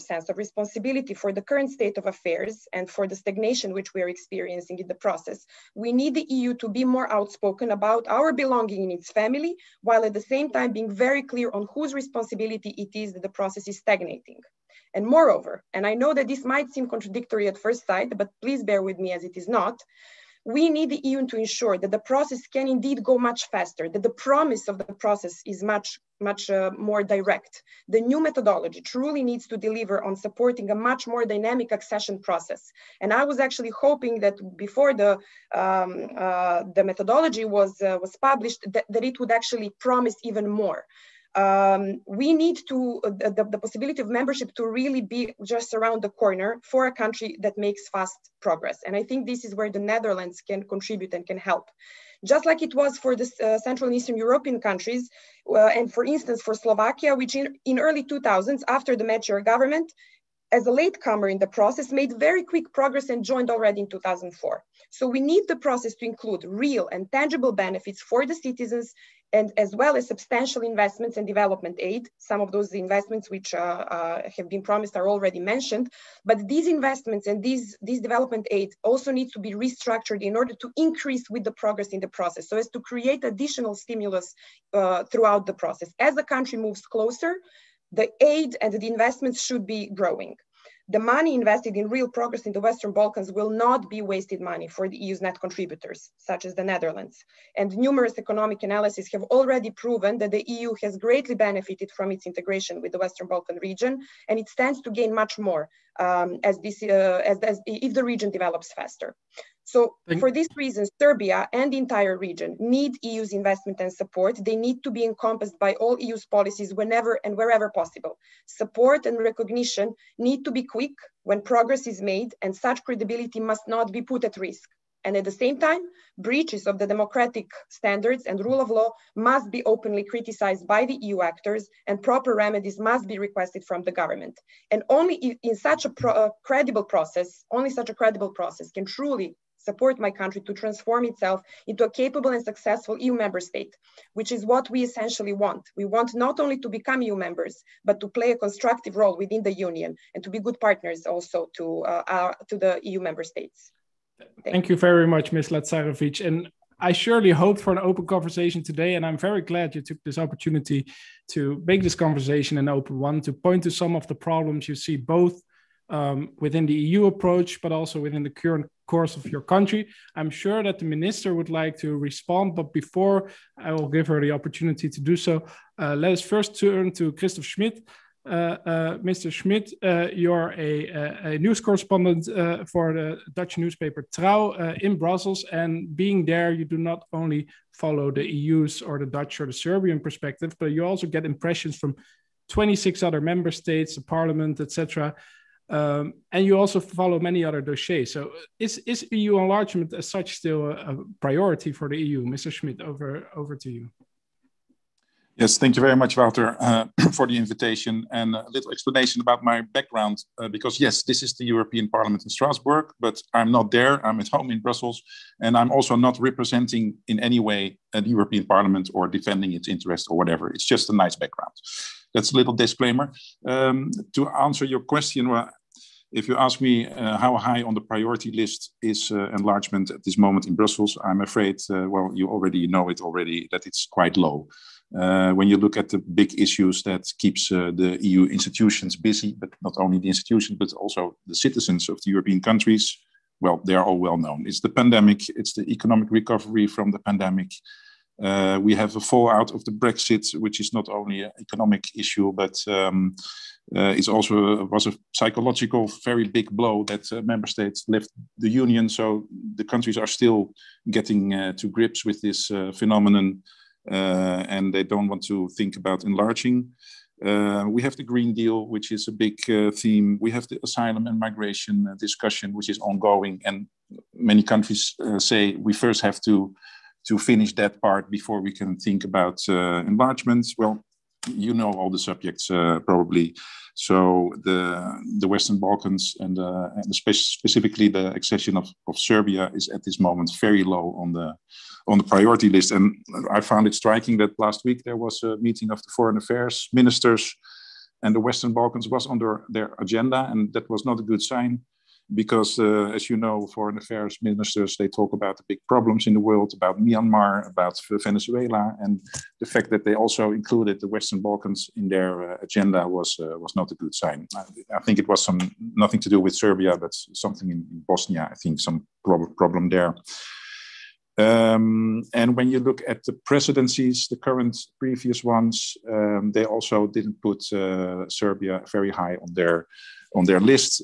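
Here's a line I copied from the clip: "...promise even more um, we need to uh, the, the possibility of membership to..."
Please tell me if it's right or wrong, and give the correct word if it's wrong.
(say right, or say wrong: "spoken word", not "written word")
right.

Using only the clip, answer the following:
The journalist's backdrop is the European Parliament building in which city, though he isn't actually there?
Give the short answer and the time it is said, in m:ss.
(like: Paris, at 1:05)
Strasbourg, at 3:32.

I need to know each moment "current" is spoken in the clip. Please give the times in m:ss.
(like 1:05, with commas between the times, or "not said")
0:01, 2:48, 5:24.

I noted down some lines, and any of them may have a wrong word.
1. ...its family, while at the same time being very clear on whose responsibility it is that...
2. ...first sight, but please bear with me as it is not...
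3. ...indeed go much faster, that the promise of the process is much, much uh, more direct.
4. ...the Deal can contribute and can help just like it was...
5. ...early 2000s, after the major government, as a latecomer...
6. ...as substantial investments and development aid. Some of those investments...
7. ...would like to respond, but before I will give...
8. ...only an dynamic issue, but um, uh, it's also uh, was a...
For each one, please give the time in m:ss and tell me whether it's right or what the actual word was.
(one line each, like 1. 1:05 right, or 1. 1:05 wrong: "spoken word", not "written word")
1. 0:08 right
2. 0:17 right
3. 0:22 right
4. 0:49 wrong: "Netherlands", not "Deal"
5. 0:57 right
6. 1:09 right
7. 2:51 right
8. 4:10 wrong: "economic", not "dynamic".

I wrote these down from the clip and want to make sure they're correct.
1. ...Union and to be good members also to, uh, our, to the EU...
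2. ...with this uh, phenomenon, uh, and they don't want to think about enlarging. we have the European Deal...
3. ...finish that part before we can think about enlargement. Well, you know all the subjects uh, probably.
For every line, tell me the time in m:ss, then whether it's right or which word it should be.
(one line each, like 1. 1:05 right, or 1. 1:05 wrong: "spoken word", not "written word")
1. 2:29 wrong: "partners", not "members"
2. 4:22 wrong: "Green", not "European"
3. 4:37 right.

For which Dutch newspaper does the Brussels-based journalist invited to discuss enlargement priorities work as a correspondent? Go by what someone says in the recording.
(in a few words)
Trouw.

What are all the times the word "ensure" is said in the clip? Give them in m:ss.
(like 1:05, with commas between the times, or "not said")
0:21.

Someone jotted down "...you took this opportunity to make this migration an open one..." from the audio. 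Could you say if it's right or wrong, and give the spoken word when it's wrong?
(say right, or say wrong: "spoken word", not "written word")
wrong: "conversation", not "migration".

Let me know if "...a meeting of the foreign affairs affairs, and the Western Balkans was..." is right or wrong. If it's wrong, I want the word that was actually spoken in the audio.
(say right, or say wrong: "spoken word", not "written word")
wrong: "ministers", not "affairs".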